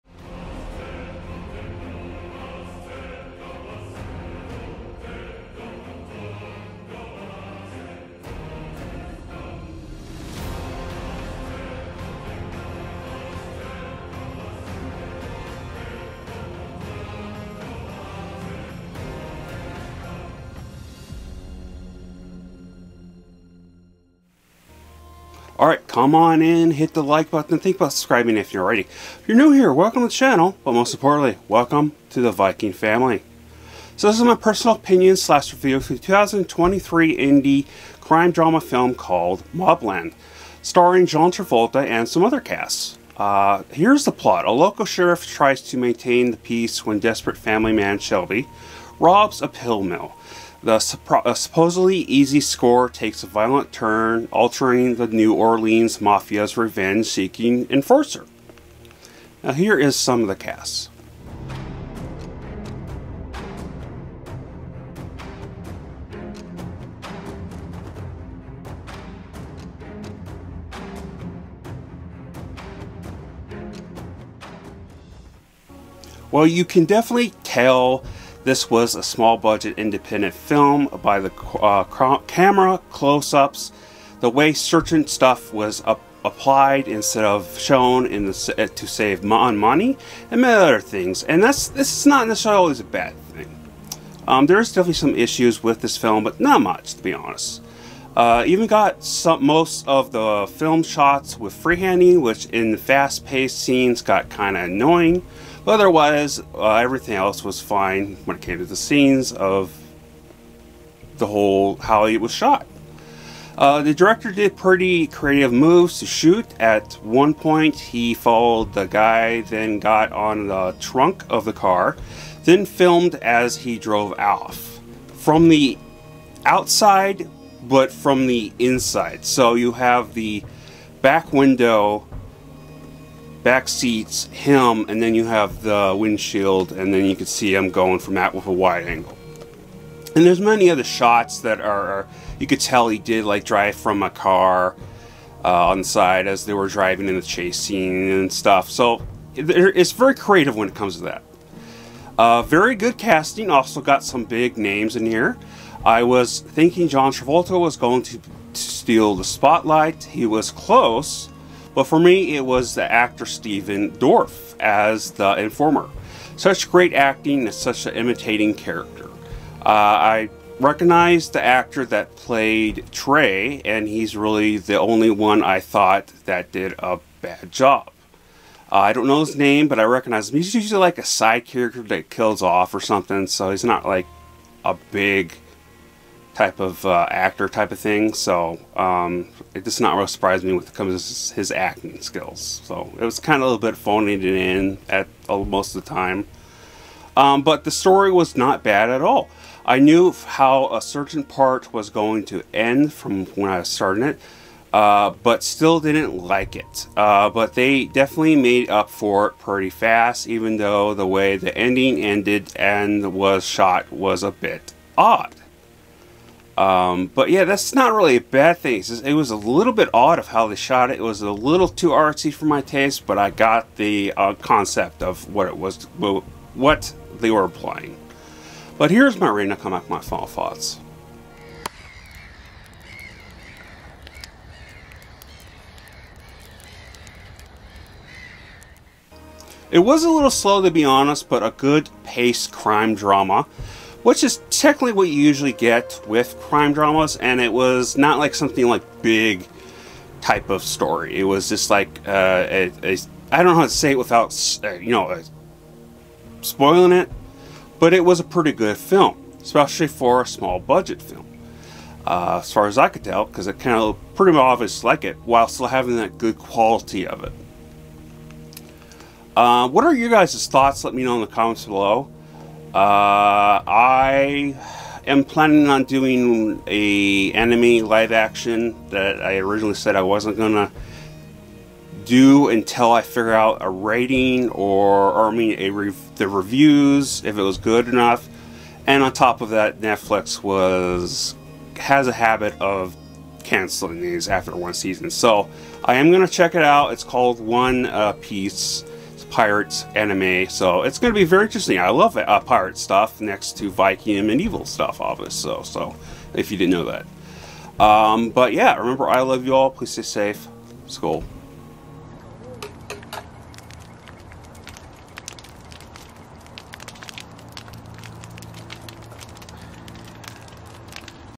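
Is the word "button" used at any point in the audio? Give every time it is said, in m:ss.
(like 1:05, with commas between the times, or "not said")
0:27.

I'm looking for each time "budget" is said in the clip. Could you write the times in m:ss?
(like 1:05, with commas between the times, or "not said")
1:19, 4:20.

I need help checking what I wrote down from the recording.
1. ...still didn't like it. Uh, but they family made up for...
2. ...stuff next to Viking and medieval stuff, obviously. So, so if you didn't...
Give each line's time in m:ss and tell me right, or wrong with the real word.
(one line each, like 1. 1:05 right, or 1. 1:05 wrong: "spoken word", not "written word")
1. 3:25 wrong: "definitely", not "family"
2. 5:02 right.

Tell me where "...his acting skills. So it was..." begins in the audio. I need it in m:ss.
3:11.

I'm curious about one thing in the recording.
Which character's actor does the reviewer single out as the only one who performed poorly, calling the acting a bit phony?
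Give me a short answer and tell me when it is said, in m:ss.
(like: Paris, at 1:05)
Trey, at 2:52.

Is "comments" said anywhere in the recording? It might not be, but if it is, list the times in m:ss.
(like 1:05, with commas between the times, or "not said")
4:31.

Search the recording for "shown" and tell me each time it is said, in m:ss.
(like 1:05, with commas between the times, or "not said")
1:27.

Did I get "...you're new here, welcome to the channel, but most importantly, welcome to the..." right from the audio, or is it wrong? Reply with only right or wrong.
right.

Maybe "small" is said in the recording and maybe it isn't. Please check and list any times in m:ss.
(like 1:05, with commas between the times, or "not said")
1:19, 4:20.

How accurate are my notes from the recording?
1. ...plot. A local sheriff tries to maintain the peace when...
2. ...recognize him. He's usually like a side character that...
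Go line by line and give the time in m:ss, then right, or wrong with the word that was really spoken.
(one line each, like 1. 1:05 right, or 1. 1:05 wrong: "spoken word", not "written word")
1. 0:44 right
2. 2:59 right.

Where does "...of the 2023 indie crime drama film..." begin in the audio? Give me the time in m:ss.
0:35.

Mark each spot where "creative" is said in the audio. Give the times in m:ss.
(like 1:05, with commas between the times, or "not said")
1:55, 2:30.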